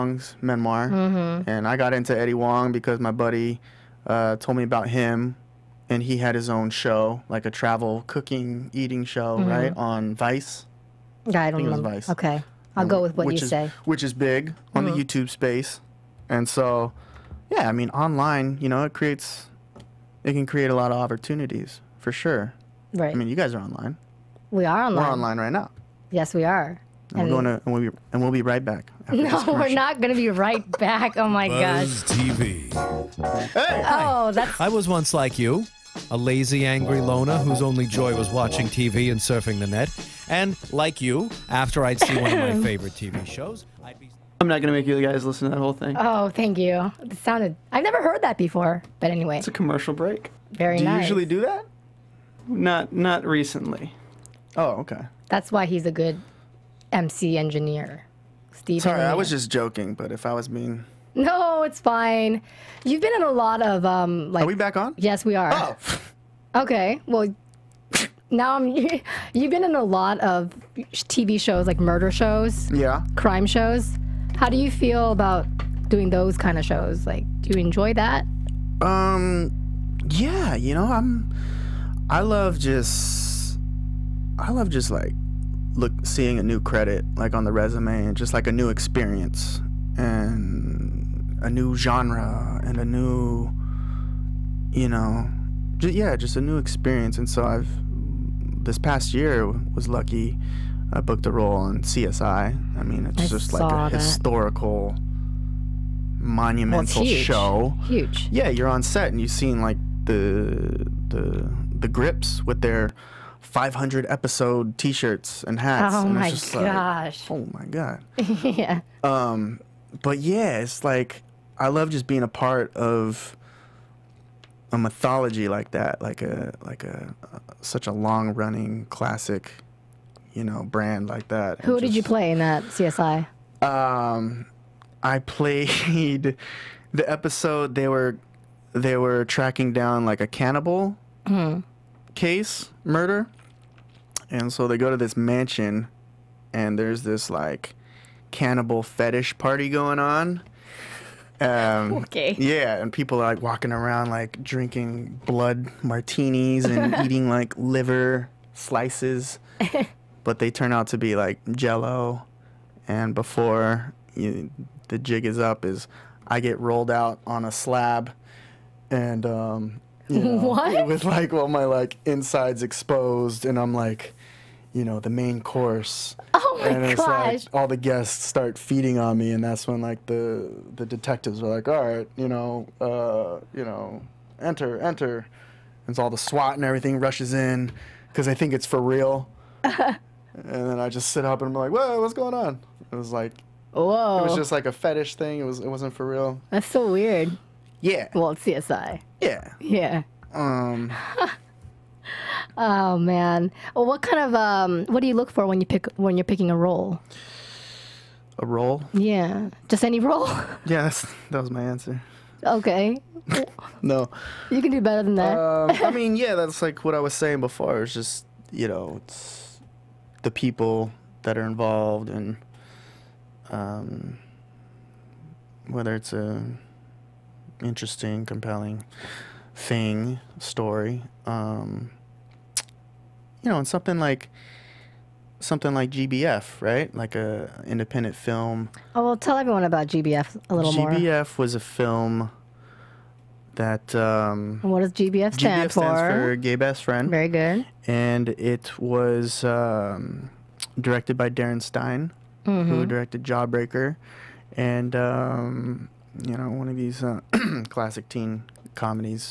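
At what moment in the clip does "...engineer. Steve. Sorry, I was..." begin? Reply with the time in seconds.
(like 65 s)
57 s.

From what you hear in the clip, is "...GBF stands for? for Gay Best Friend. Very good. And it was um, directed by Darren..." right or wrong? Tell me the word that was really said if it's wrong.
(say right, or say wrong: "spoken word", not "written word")
right.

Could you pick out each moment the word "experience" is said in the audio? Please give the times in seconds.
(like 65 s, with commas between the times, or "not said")
88 s, 96 s.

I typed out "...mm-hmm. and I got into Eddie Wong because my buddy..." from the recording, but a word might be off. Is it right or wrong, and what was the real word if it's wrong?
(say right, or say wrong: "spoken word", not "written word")
right.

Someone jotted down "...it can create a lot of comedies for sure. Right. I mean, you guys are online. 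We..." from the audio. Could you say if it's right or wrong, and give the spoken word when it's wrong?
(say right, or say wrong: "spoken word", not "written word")
wrong: "opportunities", not "comedies".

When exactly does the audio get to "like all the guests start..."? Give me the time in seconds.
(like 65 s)
177 s.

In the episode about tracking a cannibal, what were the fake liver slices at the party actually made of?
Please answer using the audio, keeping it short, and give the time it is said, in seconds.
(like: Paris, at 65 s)
Jello, at 161 s.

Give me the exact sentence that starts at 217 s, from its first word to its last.
It's just you know, it's the people that are involved and um, whether it's a interesting, compelling thing, story.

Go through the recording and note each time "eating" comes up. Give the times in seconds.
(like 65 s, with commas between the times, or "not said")
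8 s, 157 s.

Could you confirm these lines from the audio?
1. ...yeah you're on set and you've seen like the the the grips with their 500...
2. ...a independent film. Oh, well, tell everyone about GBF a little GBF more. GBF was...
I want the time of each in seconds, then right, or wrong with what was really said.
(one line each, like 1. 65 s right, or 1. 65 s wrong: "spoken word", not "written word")
1. 108 s right
2. 237 s right.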